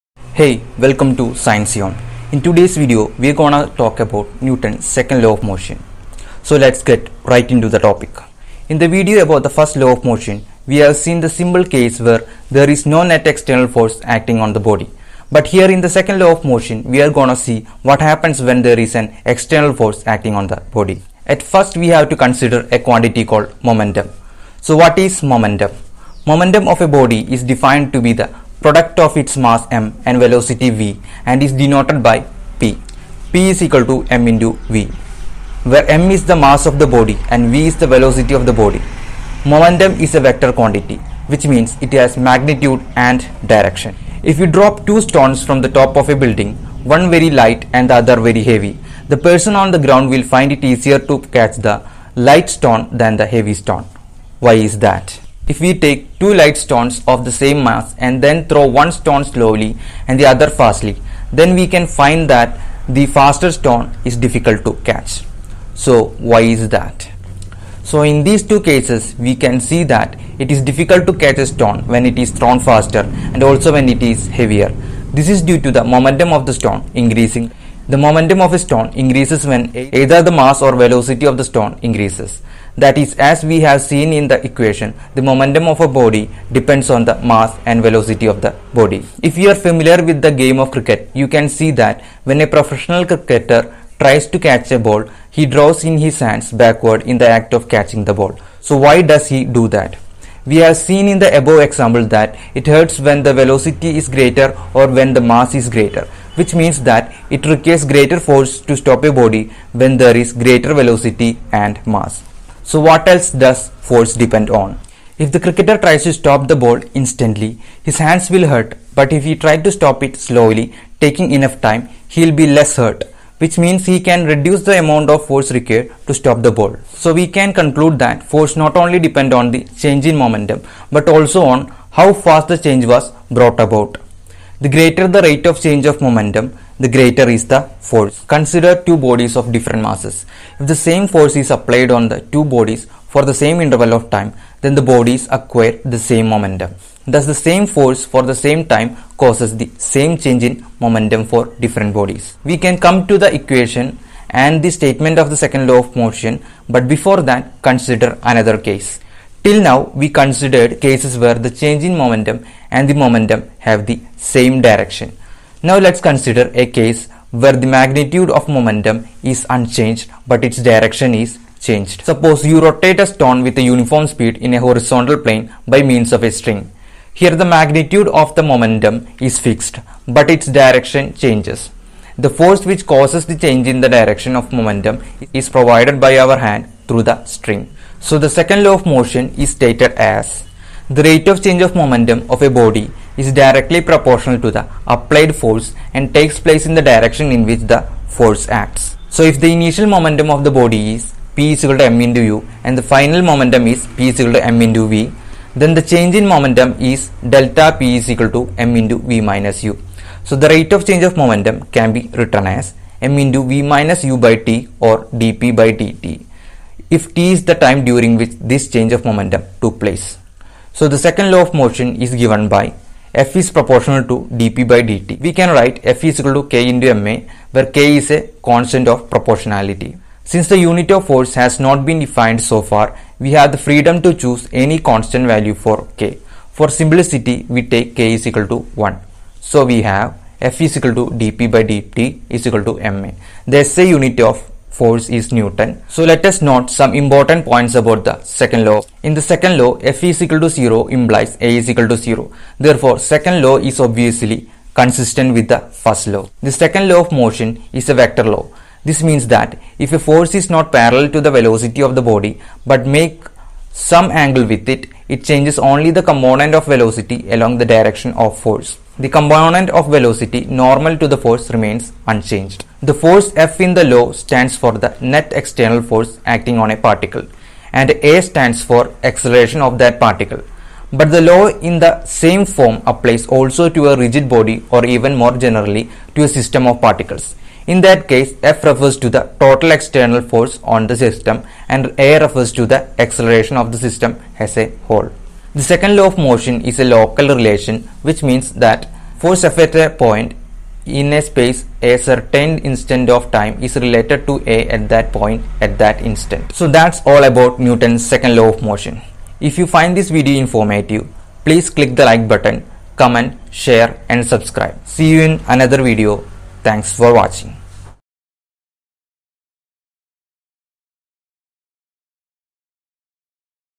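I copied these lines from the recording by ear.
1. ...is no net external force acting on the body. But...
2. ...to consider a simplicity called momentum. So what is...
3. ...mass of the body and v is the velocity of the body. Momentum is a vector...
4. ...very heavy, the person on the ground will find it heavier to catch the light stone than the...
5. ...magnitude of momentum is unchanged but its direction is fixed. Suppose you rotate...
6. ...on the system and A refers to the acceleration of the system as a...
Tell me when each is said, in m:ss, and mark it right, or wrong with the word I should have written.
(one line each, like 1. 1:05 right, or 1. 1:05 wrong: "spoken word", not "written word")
1. 0:12 right
2. 0:22 wrong: "quantity", not "simplicity"
3. 0:36 right
4. 0:48 wrong: "easier", not "heavier"
5. 2:47 wrong: "changed", not "fixed"
6. 4:50 right.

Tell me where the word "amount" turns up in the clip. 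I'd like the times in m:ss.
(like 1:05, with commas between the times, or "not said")
2:04.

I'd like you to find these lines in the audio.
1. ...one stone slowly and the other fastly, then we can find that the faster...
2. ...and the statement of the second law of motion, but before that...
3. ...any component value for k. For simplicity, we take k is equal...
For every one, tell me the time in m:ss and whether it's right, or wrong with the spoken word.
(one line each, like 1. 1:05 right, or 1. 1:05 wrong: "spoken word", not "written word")
1. 0:58 right
2. 2:34 right
3. 3:54 wrong: "constant", not "component".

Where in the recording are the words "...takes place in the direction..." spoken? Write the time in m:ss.
3:16.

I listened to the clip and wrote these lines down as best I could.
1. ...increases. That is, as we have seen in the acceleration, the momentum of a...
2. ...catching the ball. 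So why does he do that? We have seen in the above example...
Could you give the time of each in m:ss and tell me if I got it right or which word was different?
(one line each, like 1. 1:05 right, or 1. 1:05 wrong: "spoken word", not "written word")
1. 1:21 wrong: "equation", not "acceleration"
2. 1:37 right.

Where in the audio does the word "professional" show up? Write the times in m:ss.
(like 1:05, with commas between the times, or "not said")
1:32.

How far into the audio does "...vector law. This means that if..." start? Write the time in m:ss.
4:17.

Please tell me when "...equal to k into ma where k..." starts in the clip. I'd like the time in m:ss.
3:46.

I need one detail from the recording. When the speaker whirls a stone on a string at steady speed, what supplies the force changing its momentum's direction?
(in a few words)
Our hand through the string.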